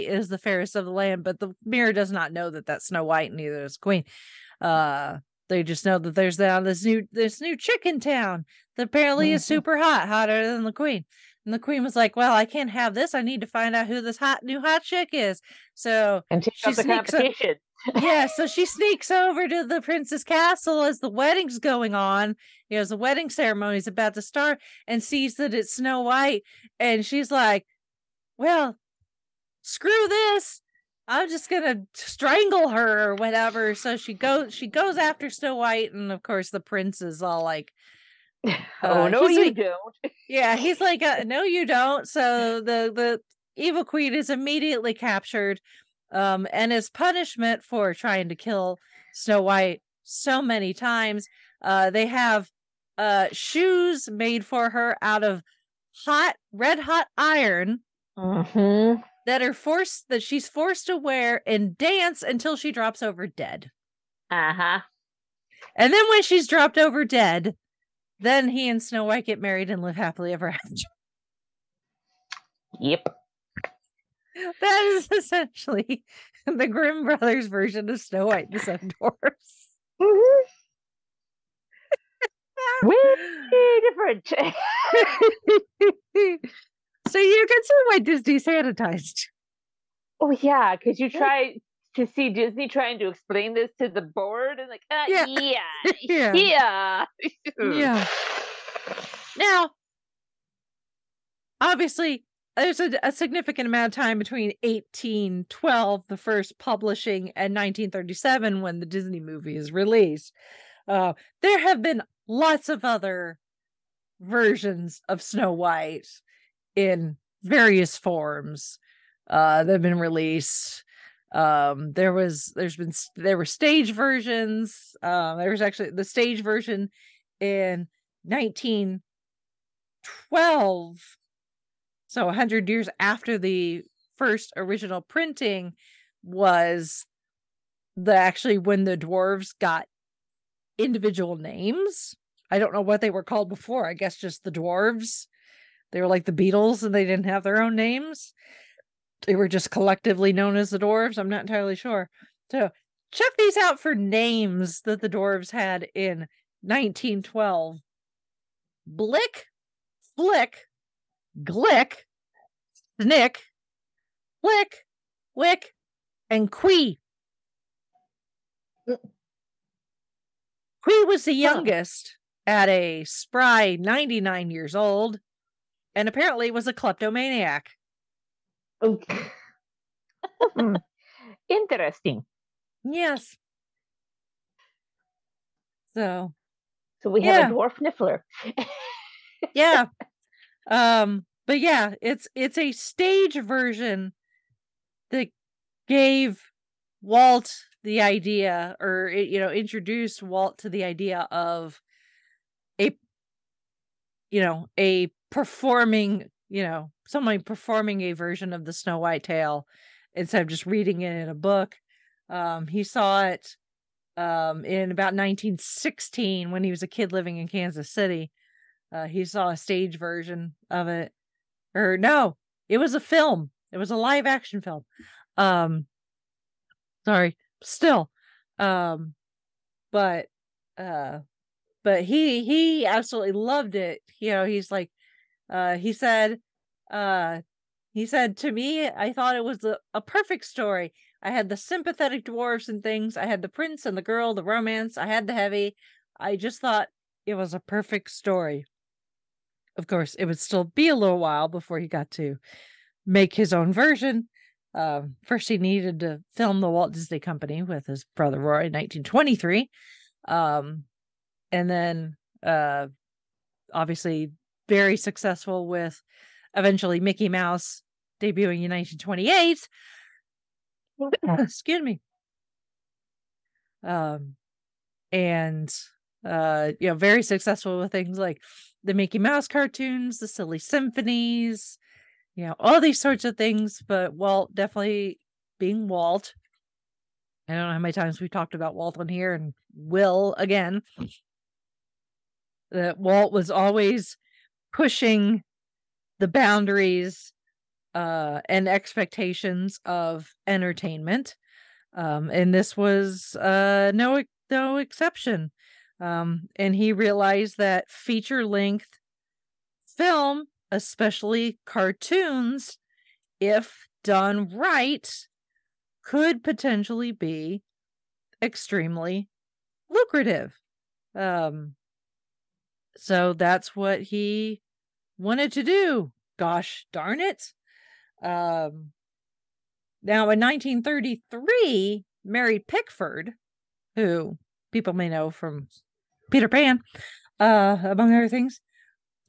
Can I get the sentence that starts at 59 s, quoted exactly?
that are forced that she's forced to wear and dance until she drops over dead.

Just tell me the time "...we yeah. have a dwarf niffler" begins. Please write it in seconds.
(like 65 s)
187 s.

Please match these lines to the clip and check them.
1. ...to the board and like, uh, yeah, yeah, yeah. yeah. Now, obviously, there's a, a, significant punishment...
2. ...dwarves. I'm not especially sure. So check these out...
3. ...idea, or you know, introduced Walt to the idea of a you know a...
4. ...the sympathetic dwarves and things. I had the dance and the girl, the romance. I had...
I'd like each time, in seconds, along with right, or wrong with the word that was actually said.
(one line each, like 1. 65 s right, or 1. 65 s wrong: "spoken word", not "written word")
1. 93 s wrong: "amount", not "punishment"
2. 150 s wrong: "entirely", not "especially"
3. 198 s right
4. 241 s wrong: "prince", not "dance".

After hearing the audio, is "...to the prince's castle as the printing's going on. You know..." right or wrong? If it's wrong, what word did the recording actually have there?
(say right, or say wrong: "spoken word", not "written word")
wrong: "wedding", not "printing".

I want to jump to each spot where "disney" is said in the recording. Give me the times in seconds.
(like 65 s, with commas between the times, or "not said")
87 s, 92 s, 108 s, 256 s.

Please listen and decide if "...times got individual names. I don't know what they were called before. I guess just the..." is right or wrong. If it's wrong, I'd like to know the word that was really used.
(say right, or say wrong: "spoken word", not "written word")
wrong: "dwarves", not "times".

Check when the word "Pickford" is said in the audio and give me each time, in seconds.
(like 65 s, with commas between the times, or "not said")
332 s.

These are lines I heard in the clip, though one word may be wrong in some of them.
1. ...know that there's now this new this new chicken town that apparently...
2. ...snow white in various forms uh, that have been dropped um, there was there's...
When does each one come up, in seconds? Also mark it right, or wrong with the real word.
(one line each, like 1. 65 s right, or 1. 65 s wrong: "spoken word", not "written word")
1. 5 s right
2. 115 s wrong: "released", not "dropped".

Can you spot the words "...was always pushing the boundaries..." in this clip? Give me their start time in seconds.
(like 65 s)
293 s.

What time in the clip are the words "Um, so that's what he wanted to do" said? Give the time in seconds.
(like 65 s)
321 s.